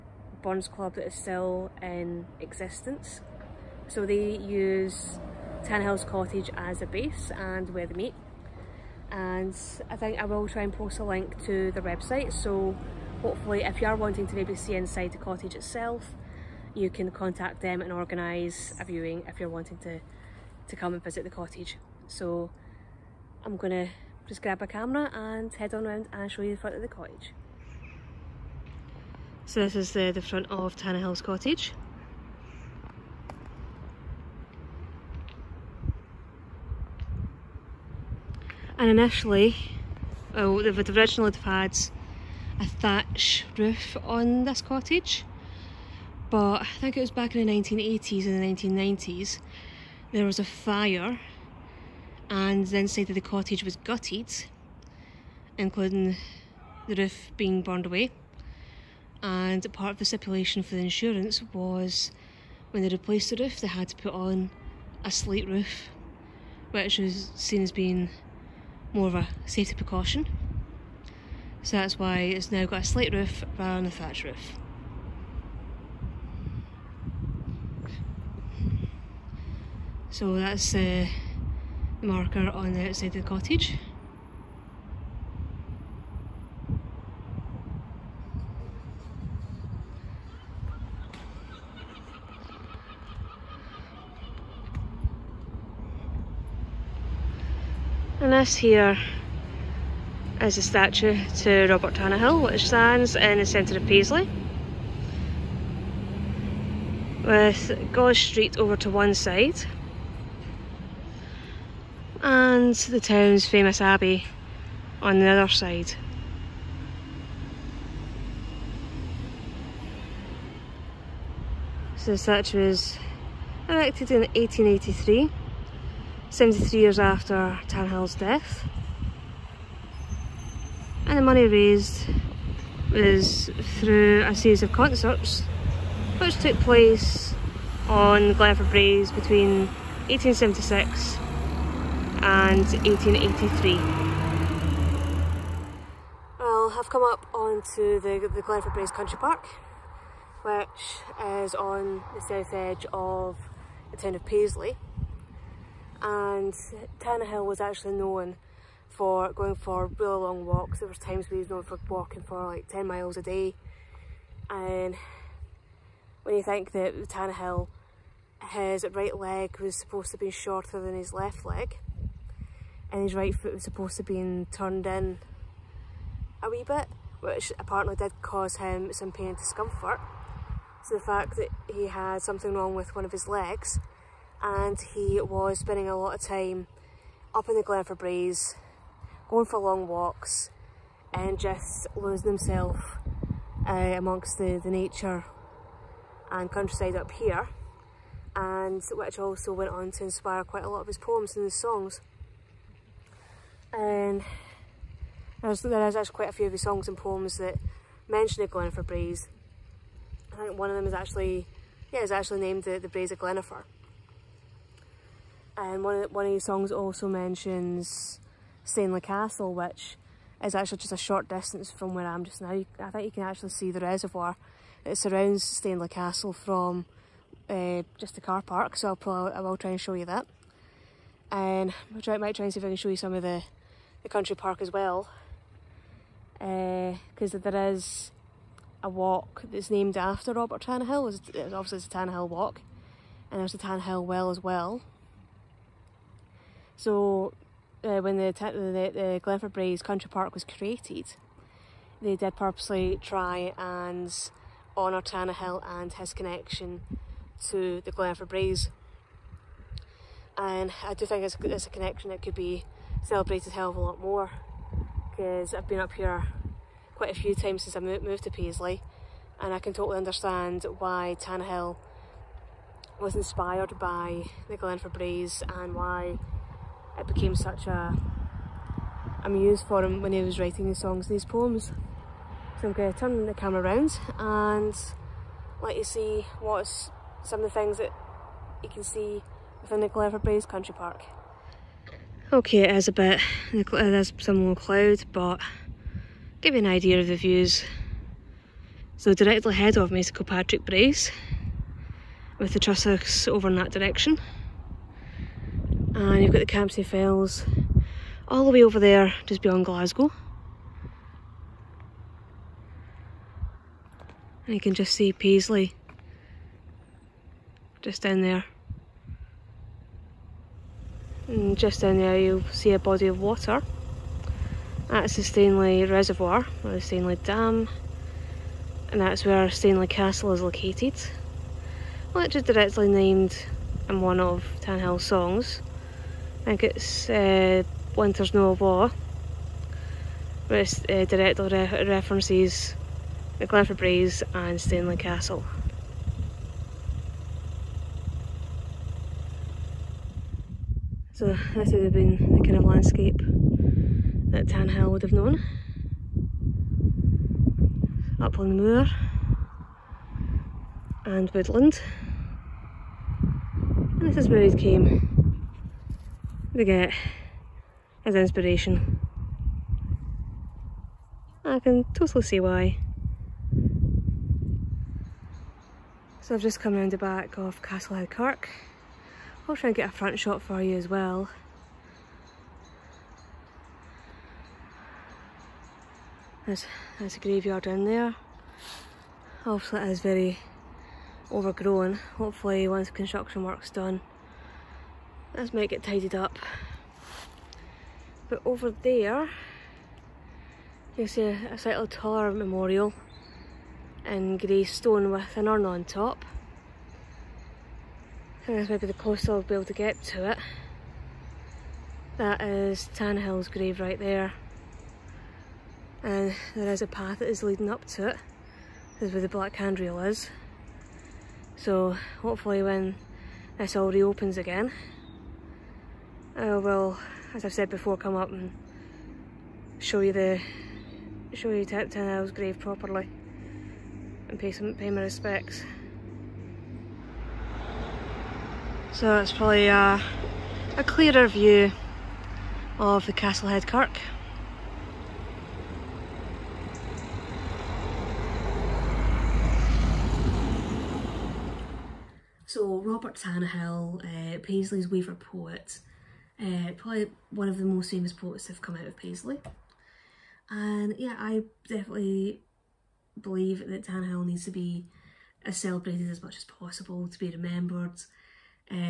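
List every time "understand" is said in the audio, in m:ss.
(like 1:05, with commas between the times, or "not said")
4:29.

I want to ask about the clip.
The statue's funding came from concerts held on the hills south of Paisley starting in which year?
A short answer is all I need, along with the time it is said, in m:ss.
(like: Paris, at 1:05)
1876, at 2:20.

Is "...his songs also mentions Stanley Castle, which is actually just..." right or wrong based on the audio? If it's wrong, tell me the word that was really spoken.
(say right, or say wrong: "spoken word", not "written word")
right.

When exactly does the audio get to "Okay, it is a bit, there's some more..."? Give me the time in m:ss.
4:52.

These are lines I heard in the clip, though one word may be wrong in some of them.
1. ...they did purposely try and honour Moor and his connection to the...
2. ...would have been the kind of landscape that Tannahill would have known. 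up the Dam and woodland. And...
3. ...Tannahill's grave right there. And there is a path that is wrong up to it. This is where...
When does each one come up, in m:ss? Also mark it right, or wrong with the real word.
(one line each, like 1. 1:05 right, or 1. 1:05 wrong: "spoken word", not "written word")
1. 4:12 wrong: "Tannahill", not "Moor"
2. 5:51 wrong: "Moor", not "Dam"
3. 6:52 wrong: "leading", not "wrong".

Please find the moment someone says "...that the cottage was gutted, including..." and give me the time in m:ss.
0:53.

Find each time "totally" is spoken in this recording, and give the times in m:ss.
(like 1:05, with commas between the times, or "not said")
4:29, 6:11.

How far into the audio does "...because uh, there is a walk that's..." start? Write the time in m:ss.
3:56.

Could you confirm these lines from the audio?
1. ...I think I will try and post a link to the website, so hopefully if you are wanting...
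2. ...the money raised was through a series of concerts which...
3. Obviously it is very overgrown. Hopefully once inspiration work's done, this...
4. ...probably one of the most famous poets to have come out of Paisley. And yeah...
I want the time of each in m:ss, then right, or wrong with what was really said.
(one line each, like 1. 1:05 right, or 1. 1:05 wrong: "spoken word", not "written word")
1. 0:09 right
2. 2:11 right
3. 6:29 wrong: "construction", not "inspiration"
4. 7:36 right.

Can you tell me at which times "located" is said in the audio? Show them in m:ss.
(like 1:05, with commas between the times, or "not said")
5:30.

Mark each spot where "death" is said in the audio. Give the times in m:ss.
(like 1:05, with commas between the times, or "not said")
2:08.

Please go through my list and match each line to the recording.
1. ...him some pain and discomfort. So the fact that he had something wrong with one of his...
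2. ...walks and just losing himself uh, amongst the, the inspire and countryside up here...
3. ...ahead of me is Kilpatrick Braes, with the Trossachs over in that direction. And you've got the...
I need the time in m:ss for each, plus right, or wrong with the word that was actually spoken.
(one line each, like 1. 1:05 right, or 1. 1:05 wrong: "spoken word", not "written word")
1. 2:58 right
2. 3:09 wrong: "nature", not "inspire"
3. 4:59 right.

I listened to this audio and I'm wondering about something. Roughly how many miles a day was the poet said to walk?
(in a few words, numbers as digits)
10.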